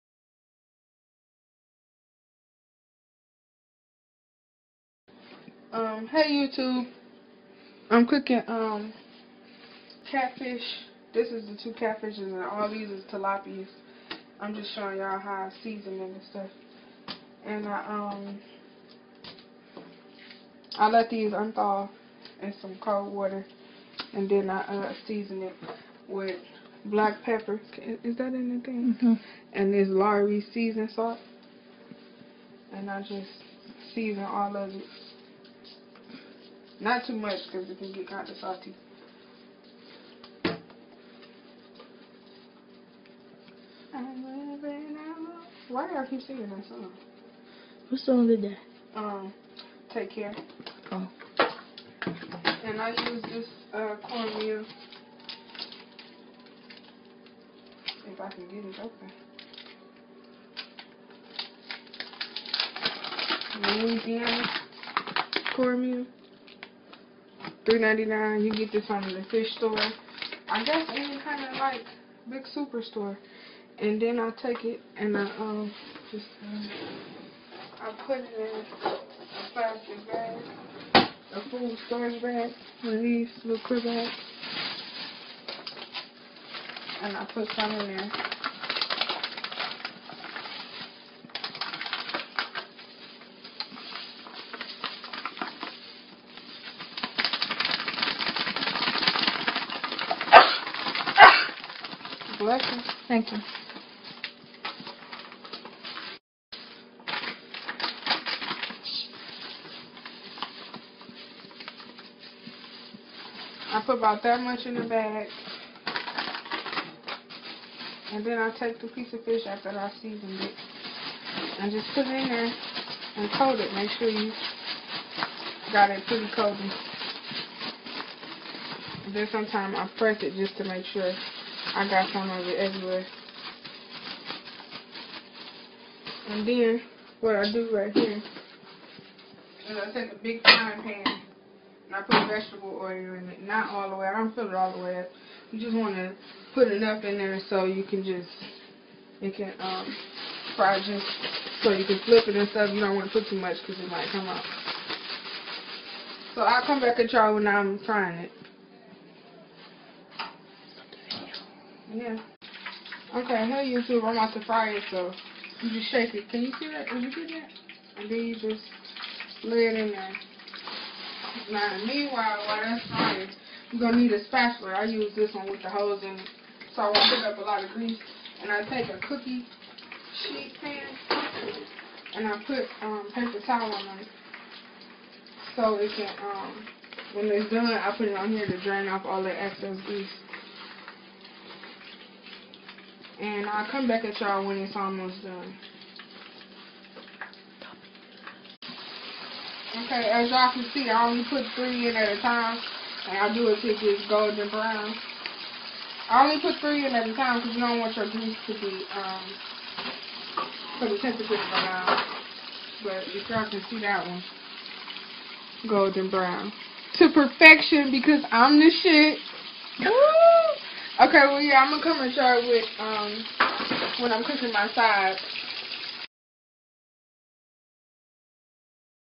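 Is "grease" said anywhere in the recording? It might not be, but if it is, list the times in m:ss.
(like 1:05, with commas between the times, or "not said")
2:57, 3:09, 3:28.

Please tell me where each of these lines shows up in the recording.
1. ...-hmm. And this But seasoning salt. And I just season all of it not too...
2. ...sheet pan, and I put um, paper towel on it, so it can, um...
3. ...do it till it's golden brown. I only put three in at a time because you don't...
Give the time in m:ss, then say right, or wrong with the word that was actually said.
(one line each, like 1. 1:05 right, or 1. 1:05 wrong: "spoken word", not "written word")
1. 0:28 wrong: "Lawry", not "But"
2. 3:00 right
3. 3:23 right.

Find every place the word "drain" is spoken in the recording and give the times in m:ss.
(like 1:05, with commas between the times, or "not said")
3:08.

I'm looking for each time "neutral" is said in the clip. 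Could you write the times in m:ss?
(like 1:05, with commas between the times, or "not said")
not said.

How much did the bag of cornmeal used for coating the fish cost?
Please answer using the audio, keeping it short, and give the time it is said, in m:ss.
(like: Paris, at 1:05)
$3.99, at 1:07.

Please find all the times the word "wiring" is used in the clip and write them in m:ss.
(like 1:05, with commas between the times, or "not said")
not said.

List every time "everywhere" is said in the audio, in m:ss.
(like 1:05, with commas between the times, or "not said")
2:12.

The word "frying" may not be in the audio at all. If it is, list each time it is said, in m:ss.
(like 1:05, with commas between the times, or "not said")
2:20, 2:37, 2:52.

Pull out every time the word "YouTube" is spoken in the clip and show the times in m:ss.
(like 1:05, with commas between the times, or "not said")
0:06, 2:43.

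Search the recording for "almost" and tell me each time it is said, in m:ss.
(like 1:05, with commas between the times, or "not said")
3:14.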